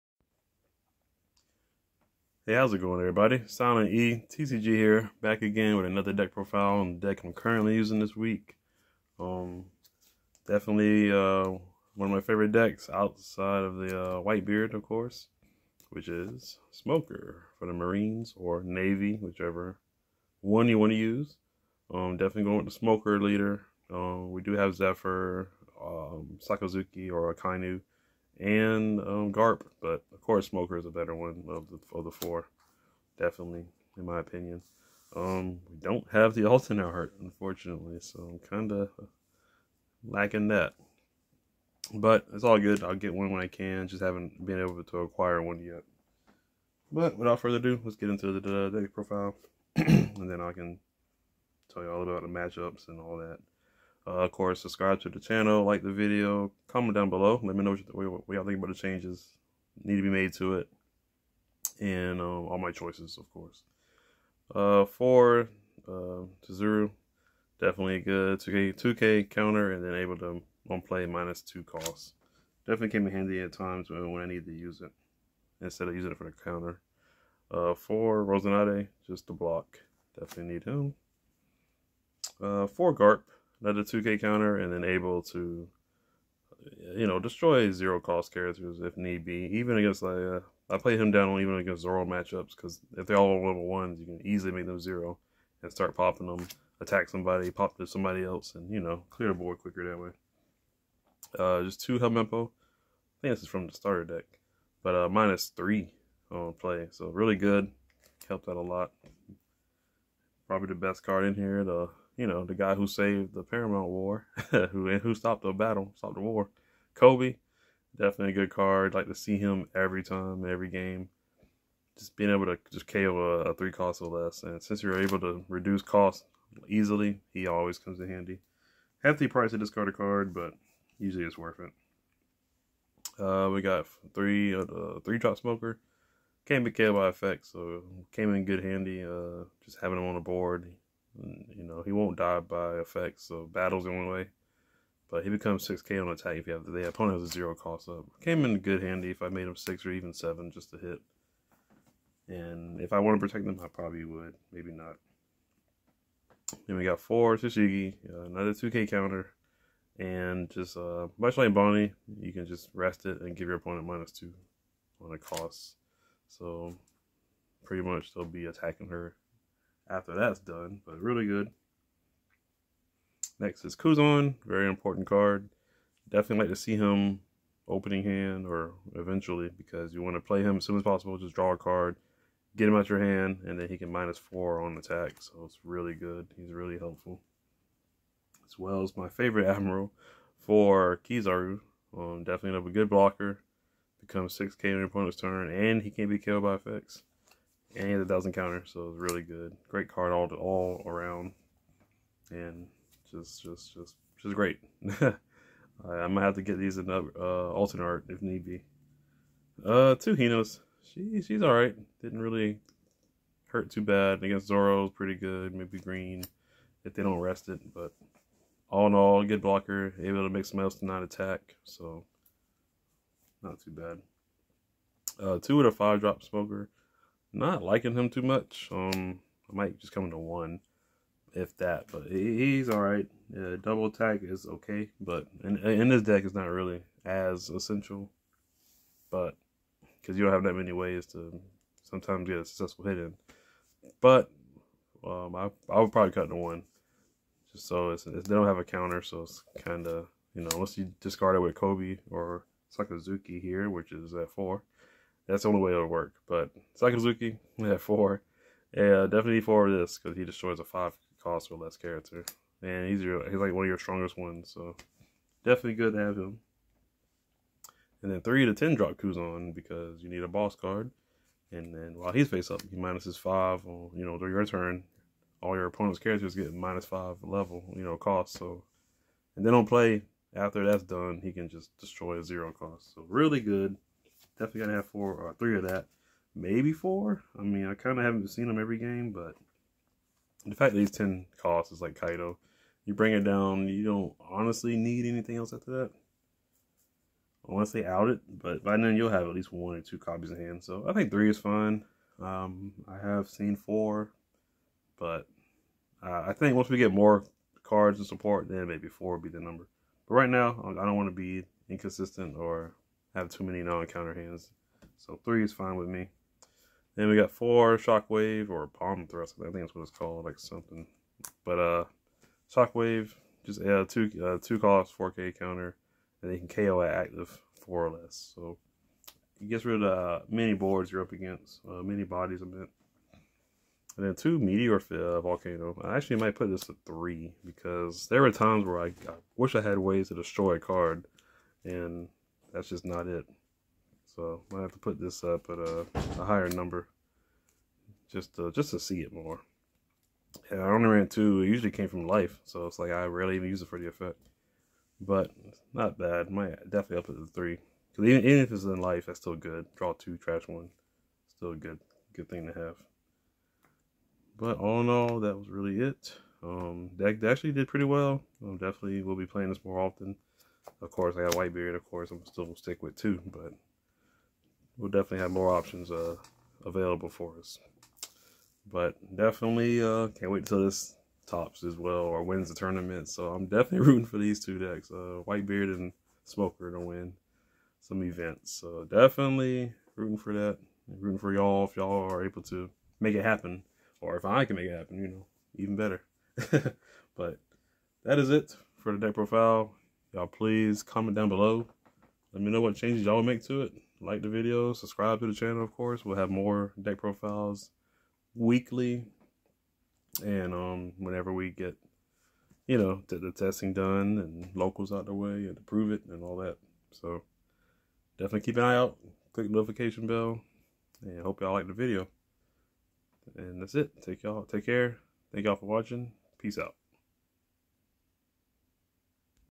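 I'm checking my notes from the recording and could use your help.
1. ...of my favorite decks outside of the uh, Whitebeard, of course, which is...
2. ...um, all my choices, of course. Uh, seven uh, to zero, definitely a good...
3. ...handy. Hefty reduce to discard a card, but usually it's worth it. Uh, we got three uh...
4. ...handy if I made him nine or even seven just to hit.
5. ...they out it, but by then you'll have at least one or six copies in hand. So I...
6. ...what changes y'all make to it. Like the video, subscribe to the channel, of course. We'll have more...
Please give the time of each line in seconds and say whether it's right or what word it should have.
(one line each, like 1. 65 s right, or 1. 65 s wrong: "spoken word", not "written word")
1. 12 s right
2. 62 s wrong: "four", not "seven"
3. 128 s wrong: "price", not "reduce"
4. 148 s wrong: "six", not "nine"
5. 297 s wrong: "two", not "six"
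6. 402 s right.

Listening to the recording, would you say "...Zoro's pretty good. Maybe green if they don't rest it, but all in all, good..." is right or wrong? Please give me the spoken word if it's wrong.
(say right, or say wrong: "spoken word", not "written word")
right.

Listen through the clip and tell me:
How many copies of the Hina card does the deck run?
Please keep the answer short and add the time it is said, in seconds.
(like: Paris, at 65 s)
2, at 209 s.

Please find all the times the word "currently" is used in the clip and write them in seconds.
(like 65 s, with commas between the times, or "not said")
7 s.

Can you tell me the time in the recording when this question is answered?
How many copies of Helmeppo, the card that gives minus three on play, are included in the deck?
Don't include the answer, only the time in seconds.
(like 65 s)
101 s.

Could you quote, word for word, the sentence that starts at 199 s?
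Great card all to, all around, and just just just just great.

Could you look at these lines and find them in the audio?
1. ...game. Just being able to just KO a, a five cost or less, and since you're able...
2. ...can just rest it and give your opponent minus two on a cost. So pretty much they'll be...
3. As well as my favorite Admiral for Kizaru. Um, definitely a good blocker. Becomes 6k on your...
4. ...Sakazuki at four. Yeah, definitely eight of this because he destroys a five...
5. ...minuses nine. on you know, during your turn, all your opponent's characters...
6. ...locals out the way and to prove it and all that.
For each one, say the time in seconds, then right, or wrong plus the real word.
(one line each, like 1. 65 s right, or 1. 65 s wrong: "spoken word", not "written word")
1. 120 s wrong: "three", not "five"
2. 162 s right
3. 188 s right
4. 256 s wrong: "four", not "eight"
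5. 272 s wrong: "five", not "nine"
6. 414 s right.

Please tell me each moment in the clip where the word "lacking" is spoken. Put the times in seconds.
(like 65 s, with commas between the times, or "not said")
40 s.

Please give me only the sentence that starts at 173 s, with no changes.
Next is Kuzan, very important card.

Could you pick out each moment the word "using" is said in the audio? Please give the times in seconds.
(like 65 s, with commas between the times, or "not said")
7 s, 75 s.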